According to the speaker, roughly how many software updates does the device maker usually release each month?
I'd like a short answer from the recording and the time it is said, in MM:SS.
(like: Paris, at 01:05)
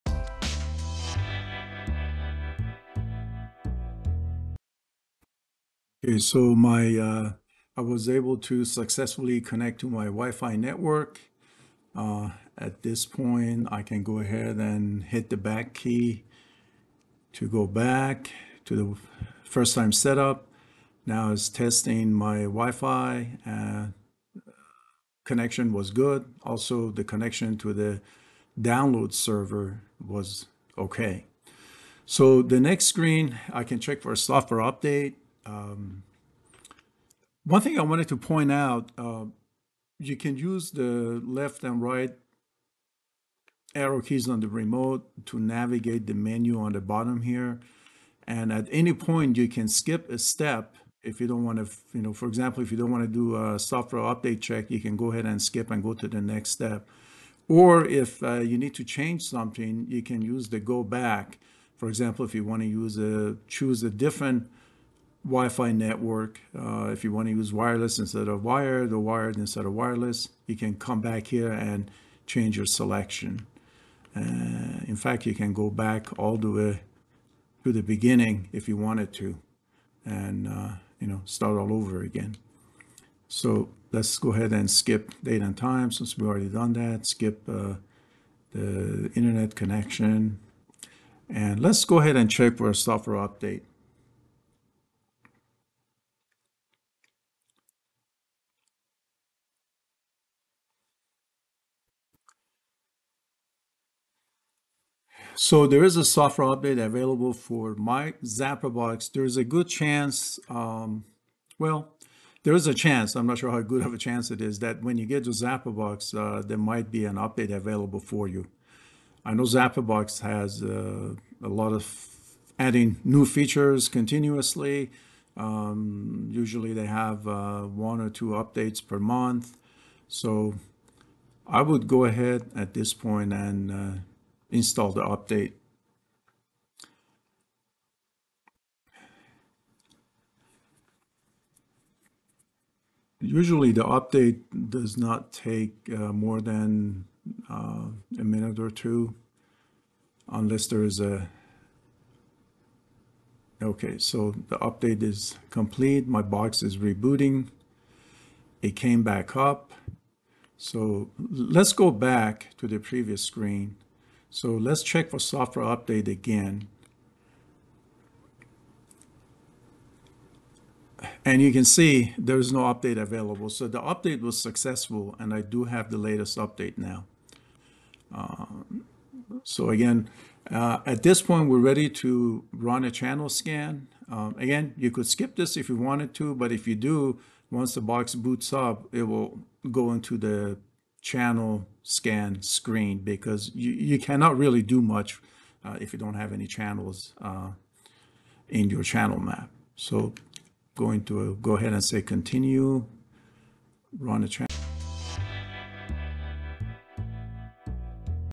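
1 or 2, at 02:07.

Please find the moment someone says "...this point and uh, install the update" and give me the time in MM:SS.
02:12.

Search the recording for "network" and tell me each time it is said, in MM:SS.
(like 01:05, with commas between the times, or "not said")
00:10, 01:05.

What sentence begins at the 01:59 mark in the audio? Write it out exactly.
I know Zapperbox has uh, a lot of adding new features continuously.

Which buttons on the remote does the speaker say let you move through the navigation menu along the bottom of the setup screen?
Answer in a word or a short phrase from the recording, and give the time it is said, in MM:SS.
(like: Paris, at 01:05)
left and right arrow keys, at 00:41.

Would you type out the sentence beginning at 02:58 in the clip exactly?
Um, so again, uh, at this point, we're ready to run a channel scan.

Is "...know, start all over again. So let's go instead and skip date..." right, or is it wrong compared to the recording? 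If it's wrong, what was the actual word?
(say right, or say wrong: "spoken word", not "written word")
wrong: "ahead", not "instead".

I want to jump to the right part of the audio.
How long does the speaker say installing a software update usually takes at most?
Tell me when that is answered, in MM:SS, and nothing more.
02:28.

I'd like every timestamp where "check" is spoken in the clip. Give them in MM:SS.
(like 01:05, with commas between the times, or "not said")
00:33, 00:54, 01:32, 02:44.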